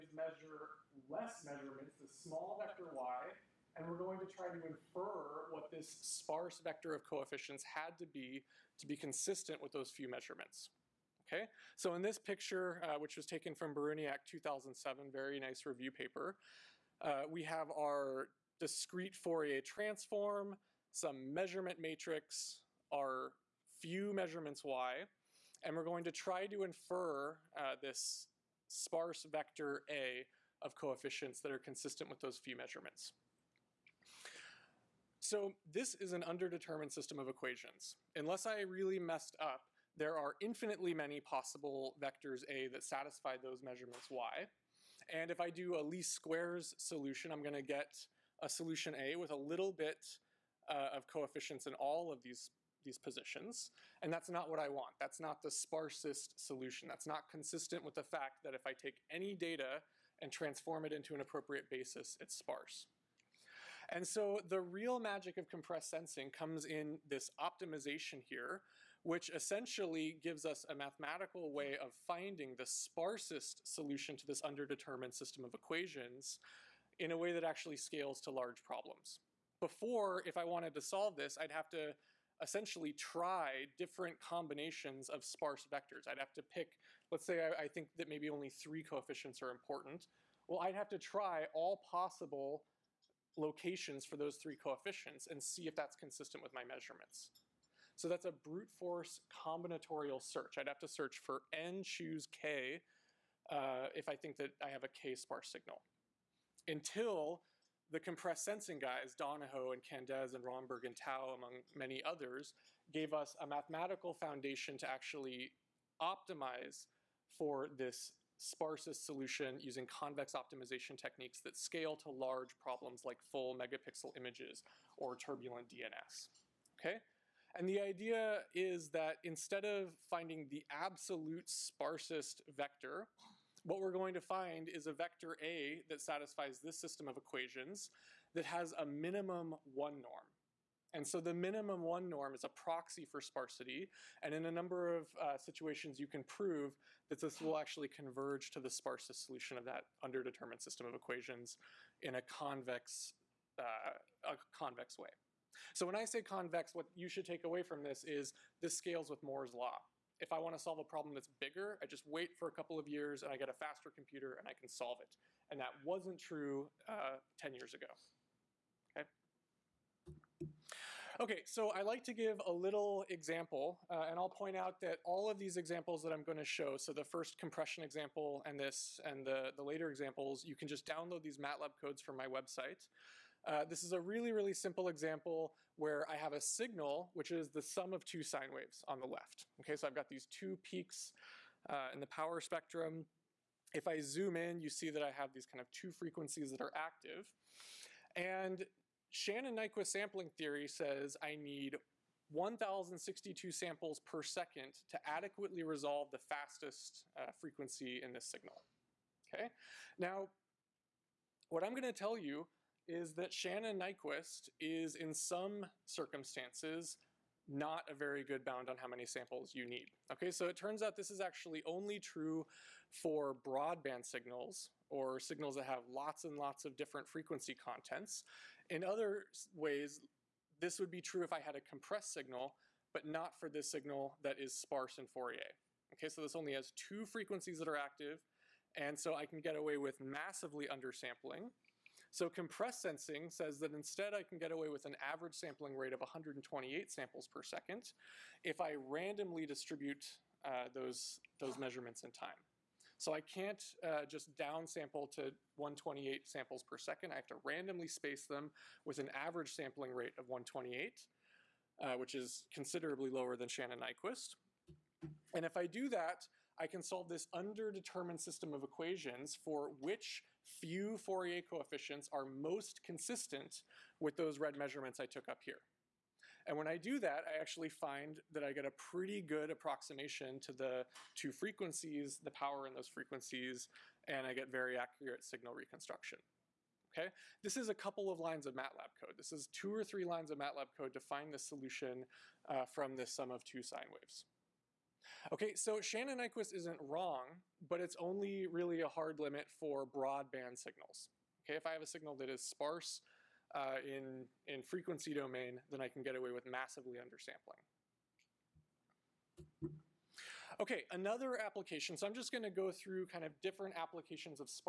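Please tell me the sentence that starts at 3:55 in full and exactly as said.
Okay, so this only has two frequencies that are active, and so I can get away with massively undersampling.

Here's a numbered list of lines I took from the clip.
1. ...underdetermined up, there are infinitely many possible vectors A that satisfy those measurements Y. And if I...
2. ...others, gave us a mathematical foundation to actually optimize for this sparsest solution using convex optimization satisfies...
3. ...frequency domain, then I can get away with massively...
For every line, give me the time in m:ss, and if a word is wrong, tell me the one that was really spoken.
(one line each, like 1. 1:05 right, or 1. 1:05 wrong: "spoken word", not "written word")
1. 0:39 wrong: "messed", not "underdetermined"
2. 1:52 wrong: "techniques", not "satisfies"
3. 5:04 right.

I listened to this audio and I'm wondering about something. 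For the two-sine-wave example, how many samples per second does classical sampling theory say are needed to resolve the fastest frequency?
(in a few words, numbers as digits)
1062.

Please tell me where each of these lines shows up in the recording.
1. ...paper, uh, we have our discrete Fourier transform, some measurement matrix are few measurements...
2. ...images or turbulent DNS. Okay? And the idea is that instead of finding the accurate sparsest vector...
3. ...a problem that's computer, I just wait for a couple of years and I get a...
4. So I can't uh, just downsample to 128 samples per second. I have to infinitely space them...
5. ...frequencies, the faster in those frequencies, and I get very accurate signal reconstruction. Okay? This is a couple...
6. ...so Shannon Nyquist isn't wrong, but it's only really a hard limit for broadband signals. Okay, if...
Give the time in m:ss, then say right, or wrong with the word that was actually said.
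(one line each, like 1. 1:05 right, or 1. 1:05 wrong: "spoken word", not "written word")
1. 0:15 right
2. 2:04 wrong: "absolute", not "accurate"
3. 2:40 wrong: "bigger", not "computer"
4. 4:12 wrong: "randomly", not "infinitely"
5. 4:41 wrong: "power", not "faster"
6. 4:55 right.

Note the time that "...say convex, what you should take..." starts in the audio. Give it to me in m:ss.
2:36.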